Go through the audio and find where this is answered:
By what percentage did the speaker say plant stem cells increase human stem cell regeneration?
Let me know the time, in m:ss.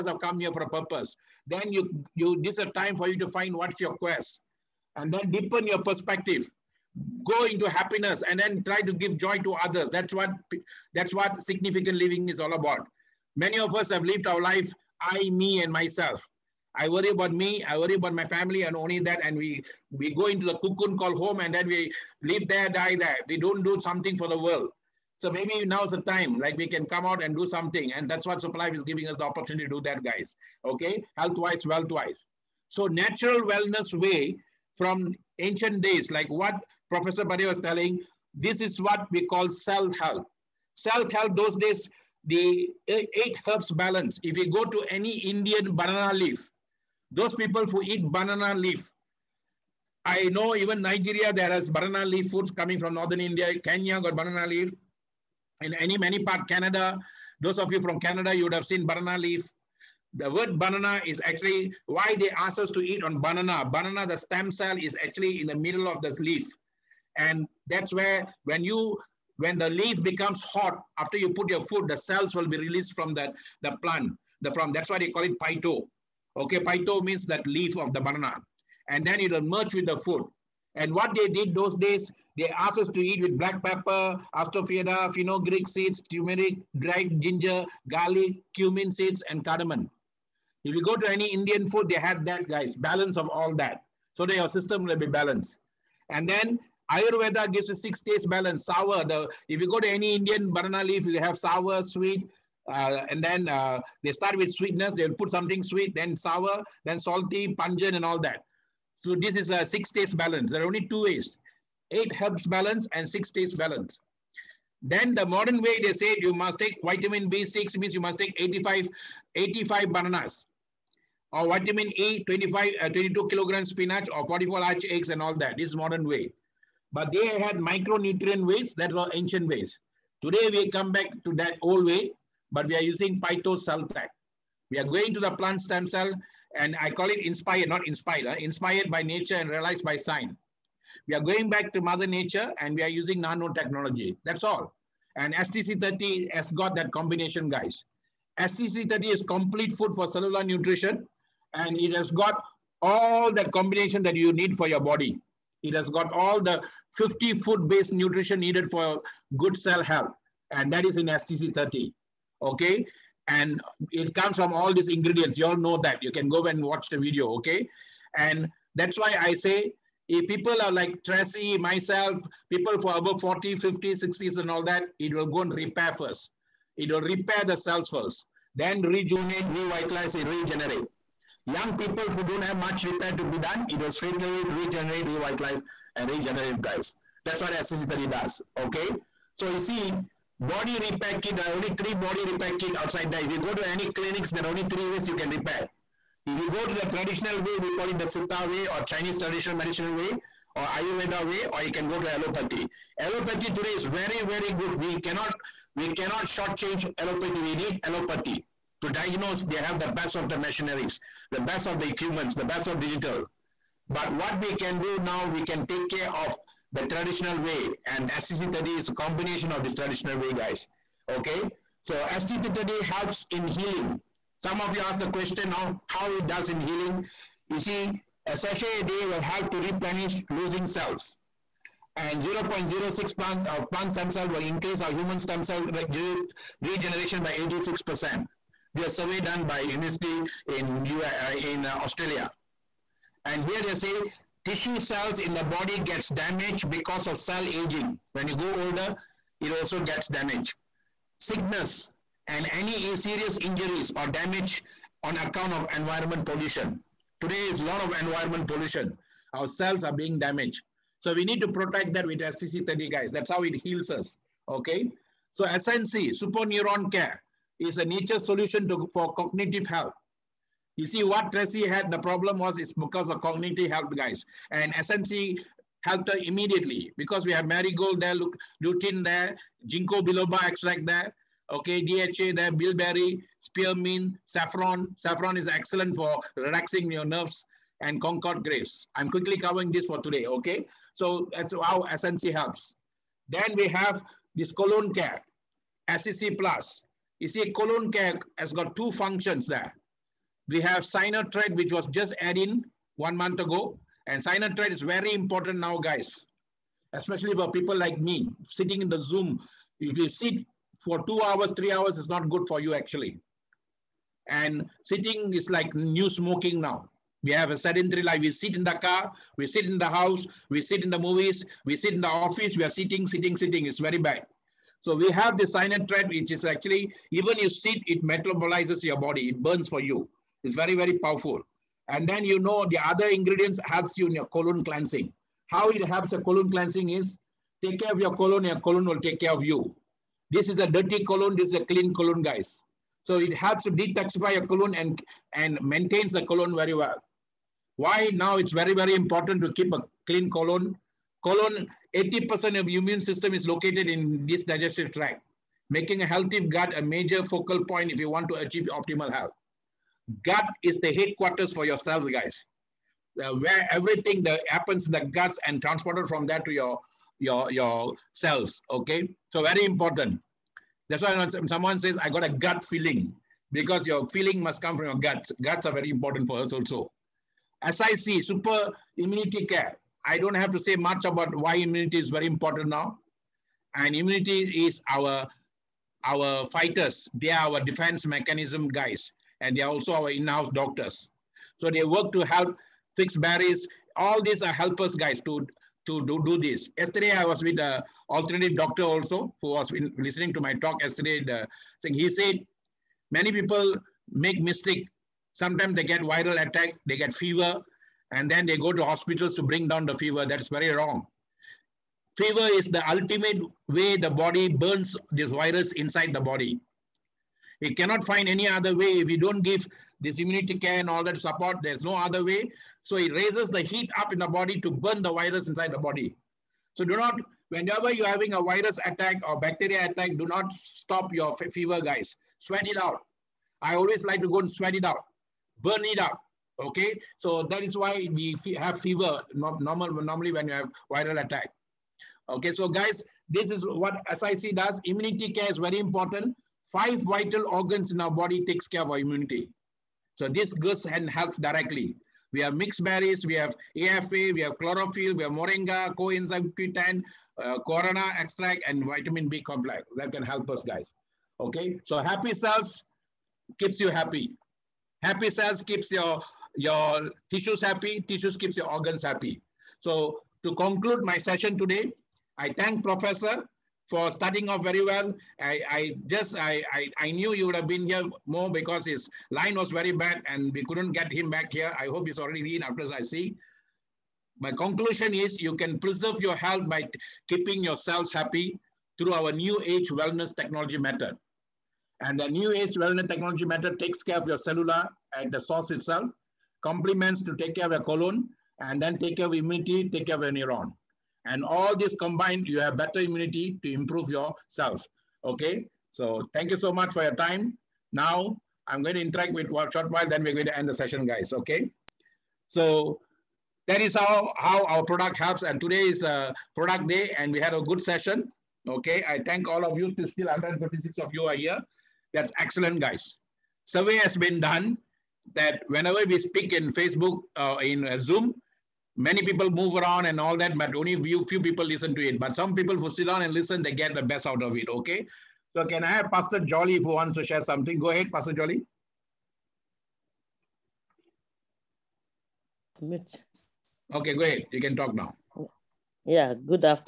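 3:57.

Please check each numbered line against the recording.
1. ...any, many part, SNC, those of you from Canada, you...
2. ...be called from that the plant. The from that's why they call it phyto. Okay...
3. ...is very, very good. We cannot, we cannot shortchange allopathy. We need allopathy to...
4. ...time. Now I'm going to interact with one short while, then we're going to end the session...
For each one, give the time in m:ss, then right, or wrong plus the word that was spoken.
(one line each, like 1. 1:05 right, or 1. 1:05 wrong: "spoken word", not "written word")
1. 0:55 wrong: "Canada", not "SNC"
2. 1:12 wrong: "released", not "called"
3. 3:23 right
4. 8:27 right.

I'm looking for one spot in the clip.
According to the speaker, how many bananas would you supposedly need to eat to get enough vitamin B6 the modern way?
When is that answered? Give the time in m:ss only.
1:59.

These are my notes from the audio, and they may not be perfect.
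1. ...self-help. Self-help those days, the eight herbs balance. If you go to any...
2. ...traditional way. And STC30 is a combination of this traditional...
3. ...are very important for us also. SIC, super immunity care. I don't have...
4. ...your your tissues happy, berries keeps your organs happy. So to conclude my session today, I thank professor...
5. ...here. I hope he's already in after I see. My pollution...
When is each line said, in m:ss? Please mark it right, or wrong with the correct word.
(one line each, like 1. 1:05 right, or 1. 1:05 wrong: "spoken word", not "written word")
1. 0:39 right
2. 3:36 right
3. 6:15 right
4. 7:45 wrong: "tissues", not "berries"
5. 8:01 wrong: "conclusion", not "pollution".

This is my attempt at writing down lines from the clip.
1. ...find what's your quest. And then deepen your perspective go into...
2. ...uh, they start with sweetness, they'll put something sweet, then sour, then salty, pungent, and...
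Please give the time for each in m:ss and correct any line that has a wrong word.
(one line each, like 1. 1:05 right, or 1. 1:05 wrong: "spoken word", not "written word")
1. 0:03 right
2. 1:43 right.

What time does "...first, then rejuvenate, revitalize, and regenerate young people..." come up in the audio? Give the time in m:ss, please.
2:57.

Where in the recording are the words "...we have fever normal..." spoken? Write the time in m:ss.
7:18.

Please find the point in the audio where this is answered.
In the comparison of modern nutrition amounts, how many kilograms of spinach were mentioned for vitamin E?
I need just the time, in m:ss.
2:02.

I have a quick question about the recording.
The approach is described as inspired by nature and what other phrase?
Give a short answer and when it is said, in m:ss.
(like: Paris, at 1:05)
realized by science, at 2:19.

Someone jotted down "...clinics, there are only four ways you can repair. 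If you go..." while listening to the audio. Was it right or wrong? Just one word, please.
wrong.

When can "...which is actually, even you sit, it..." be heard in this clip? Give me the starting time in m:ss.
5:26.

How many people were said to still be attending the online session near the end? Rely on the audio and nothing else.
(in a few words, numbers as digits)
156.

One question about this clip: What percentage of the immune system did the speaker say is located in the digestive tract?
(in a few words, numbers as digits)
80%.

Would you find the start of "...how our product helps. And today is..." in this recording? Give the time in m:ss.
8:34.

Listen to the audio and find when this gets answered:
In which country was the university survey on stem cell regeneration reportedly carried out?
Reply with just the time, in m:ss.
4:01.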